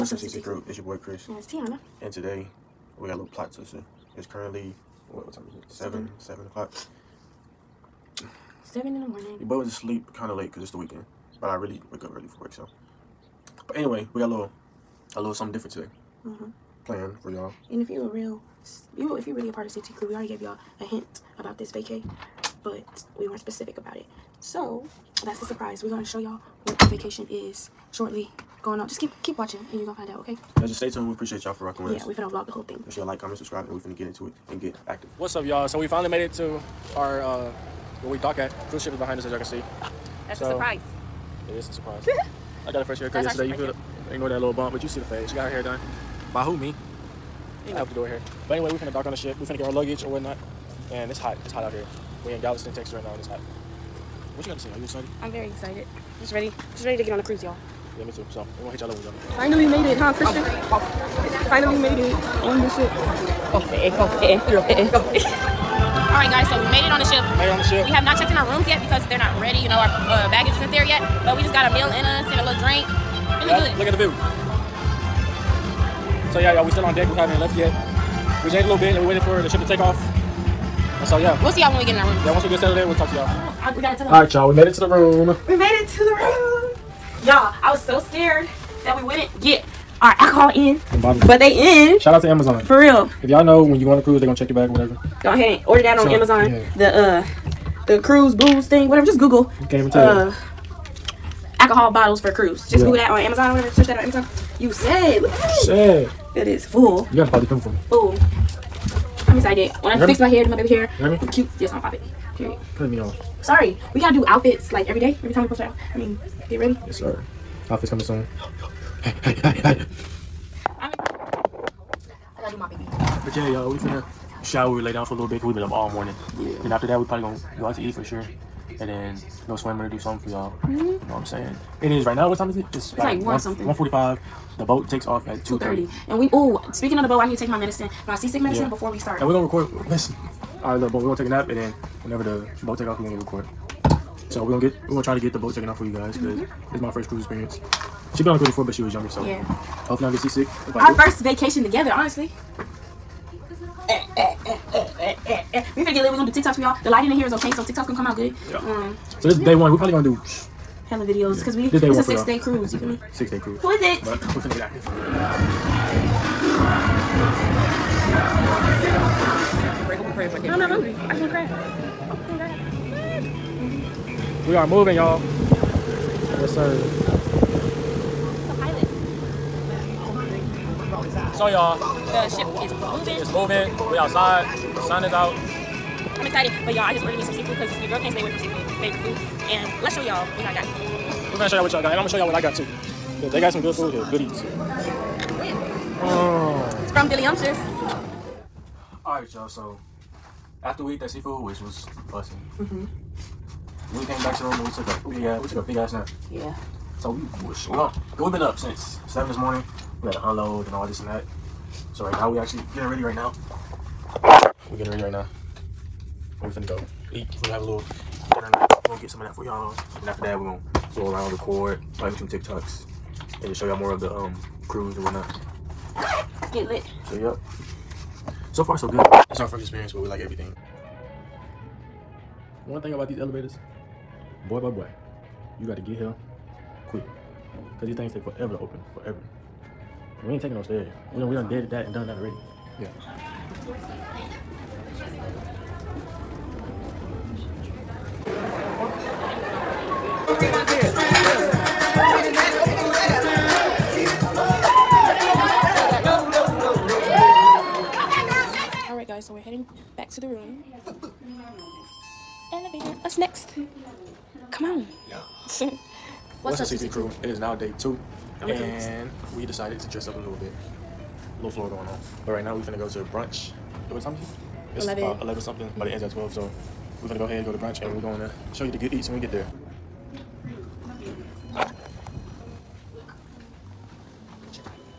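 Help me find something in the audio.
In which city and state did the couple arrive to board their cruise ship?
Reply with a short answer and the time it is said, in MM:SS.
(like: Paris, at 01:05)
Galveston, Texas, at 00:52.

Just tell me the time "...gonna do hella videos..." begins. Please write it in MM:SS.
02:39.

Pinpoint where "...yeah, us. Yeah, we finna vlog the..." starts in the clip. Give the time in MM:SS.
00:31.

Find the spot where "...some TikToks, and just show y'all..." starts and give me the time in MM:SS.
03:42.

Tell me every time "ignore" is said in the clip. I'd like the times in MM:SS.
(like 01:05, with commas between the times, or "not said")
00:44.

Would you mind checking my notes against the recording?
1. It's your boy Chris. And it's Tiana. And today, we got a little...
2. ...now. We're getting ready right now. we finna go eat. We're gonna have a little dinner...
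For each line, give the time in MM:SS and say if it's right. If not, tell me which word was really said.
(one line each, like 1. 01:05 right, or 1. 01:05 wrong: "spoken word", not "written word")
1. 00:00 right
2. 03:33 right.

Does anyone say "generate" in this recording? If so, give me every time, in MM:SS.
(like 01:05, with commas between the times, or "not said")
not said.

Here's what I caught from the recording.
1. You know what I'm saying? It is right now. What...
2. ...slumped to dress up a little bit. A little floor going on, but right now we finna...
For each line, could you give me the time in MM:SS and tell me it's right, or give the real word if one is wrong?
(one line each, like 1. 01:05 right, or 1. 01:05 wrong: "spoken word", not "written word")
1. 02:10 right
2. 04:29 wrong: "decided", not "slumped".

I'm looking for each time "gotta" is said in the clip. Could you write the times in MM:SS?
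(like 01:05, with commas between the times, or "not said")
01:23, 01:47, 01:54, 02:02.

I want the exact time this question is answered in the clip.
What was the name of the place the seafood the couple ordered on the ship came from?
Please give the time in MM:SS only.
03:17.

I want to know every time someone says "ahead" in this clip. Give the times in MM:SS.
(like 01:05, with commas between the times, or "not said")
01:35, 04:37.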